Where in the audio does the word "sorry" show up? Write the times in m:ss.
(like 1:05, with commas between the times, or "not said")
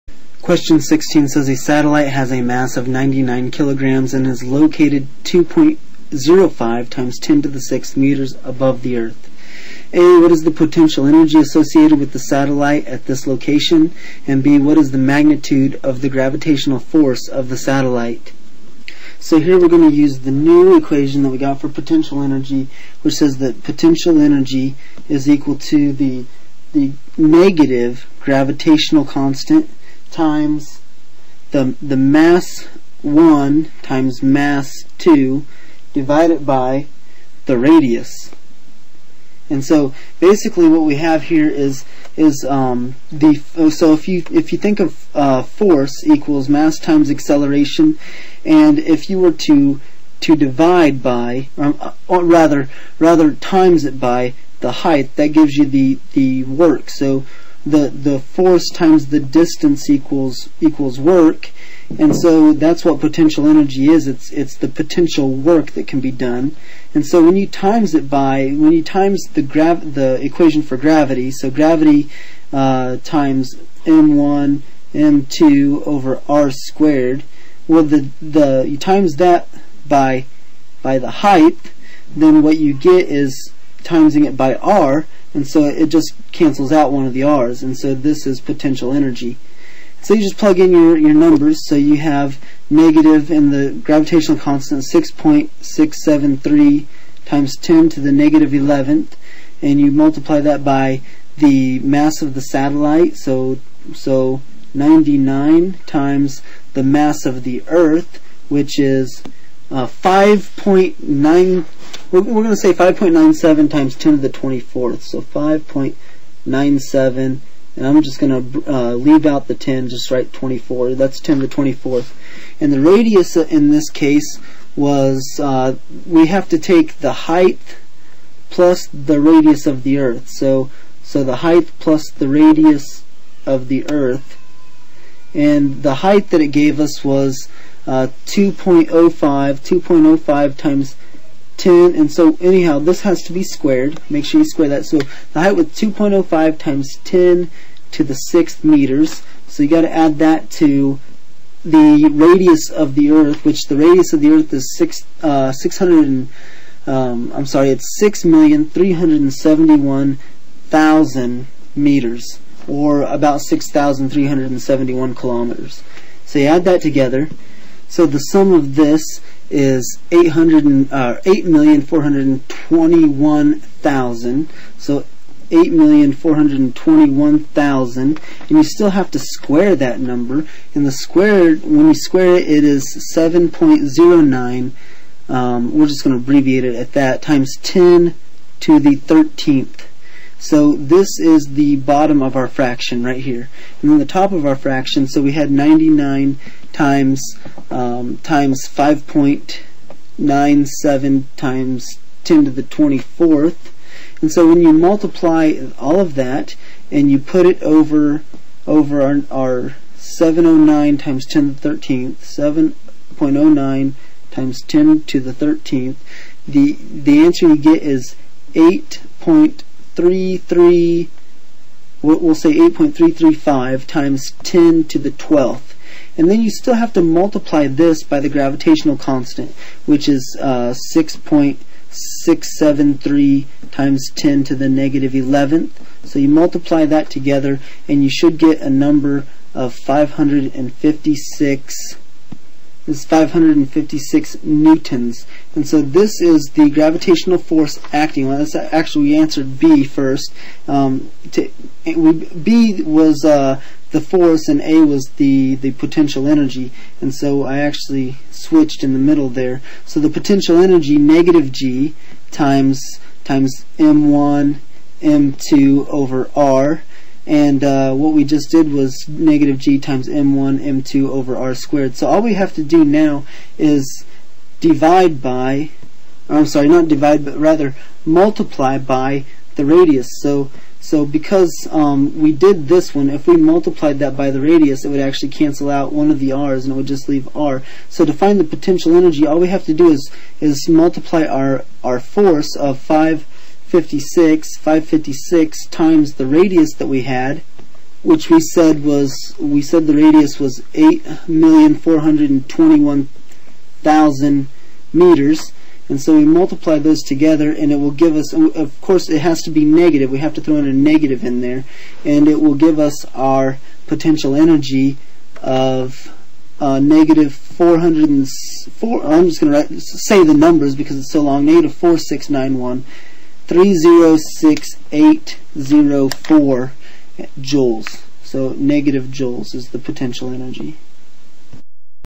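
2:37, 4:36.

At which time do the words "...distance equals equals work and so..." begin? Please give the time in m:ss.
0:59.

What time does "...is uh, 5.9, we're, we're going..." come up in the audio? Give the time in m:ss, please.
1:48.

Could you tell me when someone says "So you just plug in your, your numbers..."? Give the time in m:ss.
1:30.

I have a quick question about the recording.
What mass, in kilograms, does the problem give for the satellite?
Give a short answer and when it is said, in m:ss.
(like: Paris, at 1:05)
99, at 0:02.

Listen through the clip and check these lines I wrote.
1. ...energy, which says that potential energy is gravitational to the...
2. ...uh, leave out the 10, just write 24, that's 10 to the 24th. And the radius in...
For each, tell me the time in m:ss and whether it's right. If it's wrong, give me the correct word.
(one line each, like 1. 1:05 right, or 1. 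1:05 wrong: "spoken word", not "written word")
1. 0:22 wrong: "equal", not "gravitational"
2. 1:58 right.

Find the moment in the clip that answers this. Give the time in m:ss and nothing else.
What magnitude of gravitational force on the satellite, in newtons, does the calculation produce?
4:03.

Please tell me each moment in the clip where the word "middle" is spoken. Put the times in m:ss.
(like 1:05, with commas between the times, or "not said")
4:18.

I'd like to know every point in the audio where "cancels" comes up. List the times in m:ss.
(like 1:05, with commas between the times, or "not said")
1:26, 4:45.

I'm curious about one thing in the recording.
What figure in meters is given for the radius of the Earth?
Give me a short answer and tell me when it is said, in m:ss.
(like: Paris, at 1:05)
6,371,000 meters, at 2:37.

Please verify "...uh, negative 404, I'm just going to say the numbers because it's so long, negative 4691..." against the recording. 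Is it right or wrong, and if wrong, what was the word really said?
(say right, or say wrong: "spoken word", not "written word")
right.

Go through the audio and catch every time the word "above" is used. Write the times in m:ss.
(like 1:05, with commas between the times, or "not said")
0:08.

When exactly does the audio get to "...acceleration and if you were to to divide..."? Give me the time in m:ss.
0:47.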